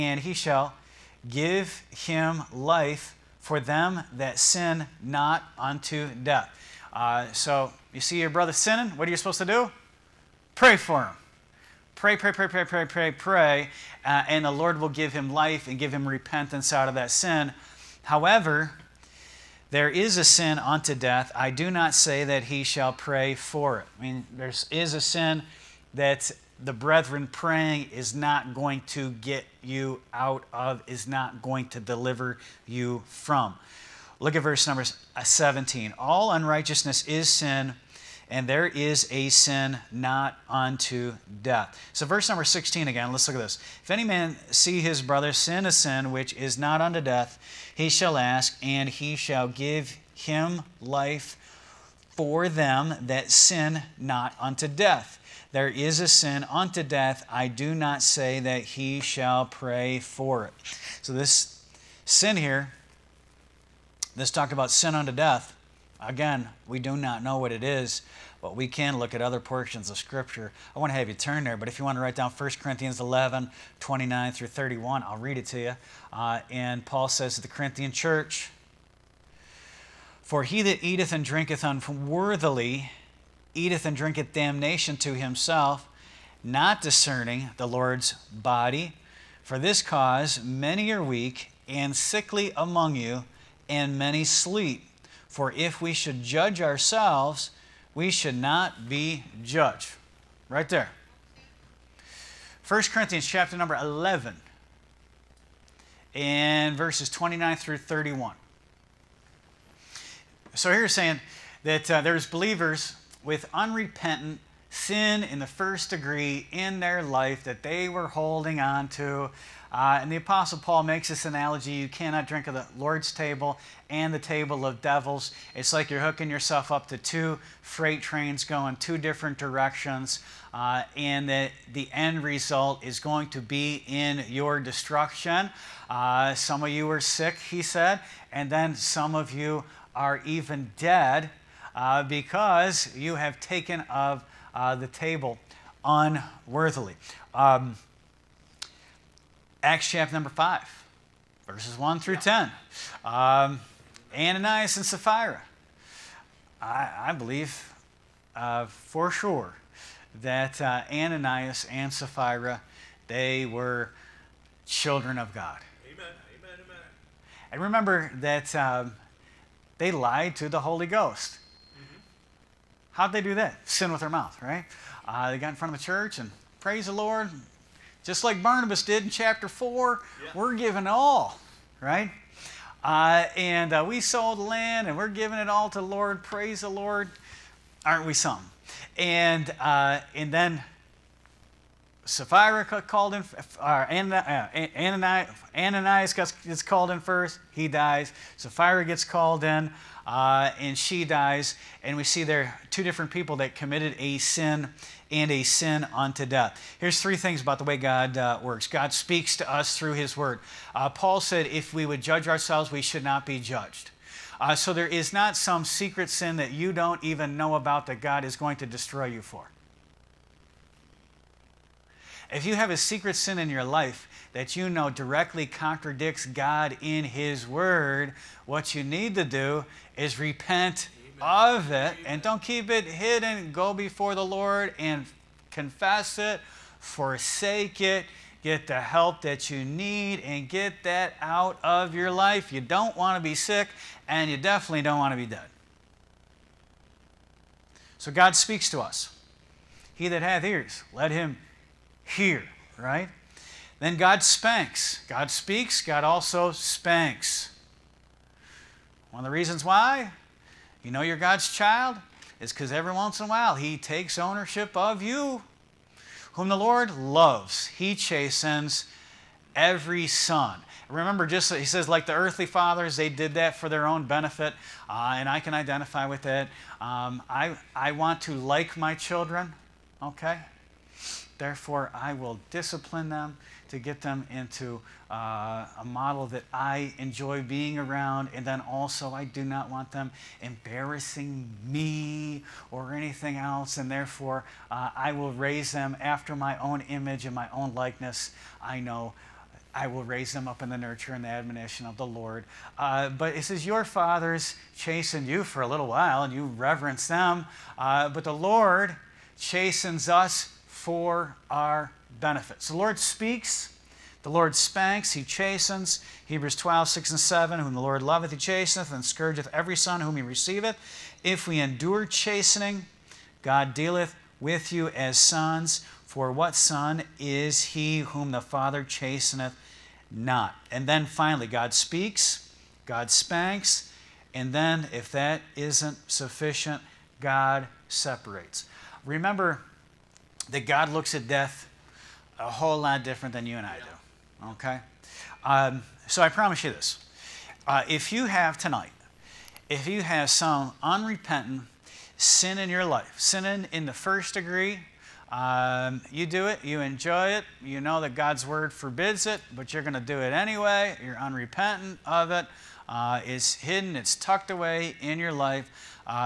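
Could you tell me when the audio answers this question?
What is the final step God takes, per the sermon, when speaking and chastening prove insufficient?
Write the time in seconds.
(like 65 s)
337 s.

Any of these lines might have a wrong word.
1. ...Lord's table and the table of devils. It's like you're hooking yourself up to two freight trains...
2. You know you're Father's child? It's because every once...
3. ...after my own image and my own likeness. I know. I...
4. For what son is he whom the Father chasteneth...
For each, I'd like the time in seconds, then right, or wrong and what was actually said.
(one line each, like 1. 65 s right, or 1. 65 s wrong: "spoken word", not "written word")
1. 122 s right
2. 260 s wrong: "God", not "Father"
3. 296 s right
4. 326 s right.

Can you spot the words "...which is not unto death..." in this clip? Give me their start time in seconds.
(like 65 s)
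46 s.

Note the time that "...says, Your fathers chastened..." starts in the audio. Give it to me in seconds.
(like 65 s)
303 s.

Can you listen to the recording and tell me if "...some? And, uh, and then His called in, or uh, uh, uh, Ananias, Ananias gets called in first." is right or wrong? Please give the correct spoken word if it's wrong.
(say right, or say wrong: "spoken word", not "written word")
wrong: "Sapphira", not "His".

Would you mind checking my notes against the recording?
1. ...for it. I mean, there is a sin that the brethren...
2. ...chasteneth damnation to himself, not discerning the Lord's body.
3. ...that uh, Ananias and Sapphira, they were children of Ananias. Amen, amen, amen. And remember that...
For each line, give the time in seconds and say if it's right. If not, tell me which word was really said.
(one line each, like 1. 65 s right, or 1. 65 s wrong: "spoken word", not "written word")
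1. 23 s right
2. 83 s wrong: "drinketh", not "chasteneth"
3. 160 s wrong: "God", not "Ananias".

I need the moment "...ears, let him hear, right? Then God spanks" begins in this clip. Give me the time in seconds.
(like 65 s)
250 s.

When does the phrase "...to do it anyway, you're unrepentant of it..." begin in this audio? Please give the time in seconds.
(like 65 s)
359 s.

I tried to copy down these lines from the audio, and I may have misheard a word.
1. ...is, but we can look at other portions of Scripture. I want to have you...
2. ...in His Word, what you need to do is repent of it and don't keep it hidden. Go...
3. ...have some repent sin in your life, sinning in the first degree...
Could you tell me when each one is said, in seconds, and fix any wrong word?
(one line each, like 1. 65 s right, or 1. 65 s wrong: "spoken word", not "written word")
1. 67 s right
2. 226 s right
3. 350 s wrong: "unrepentant", not "repent".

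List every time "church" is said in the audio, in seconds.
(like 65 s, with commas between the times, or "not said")
77 s, 175 s.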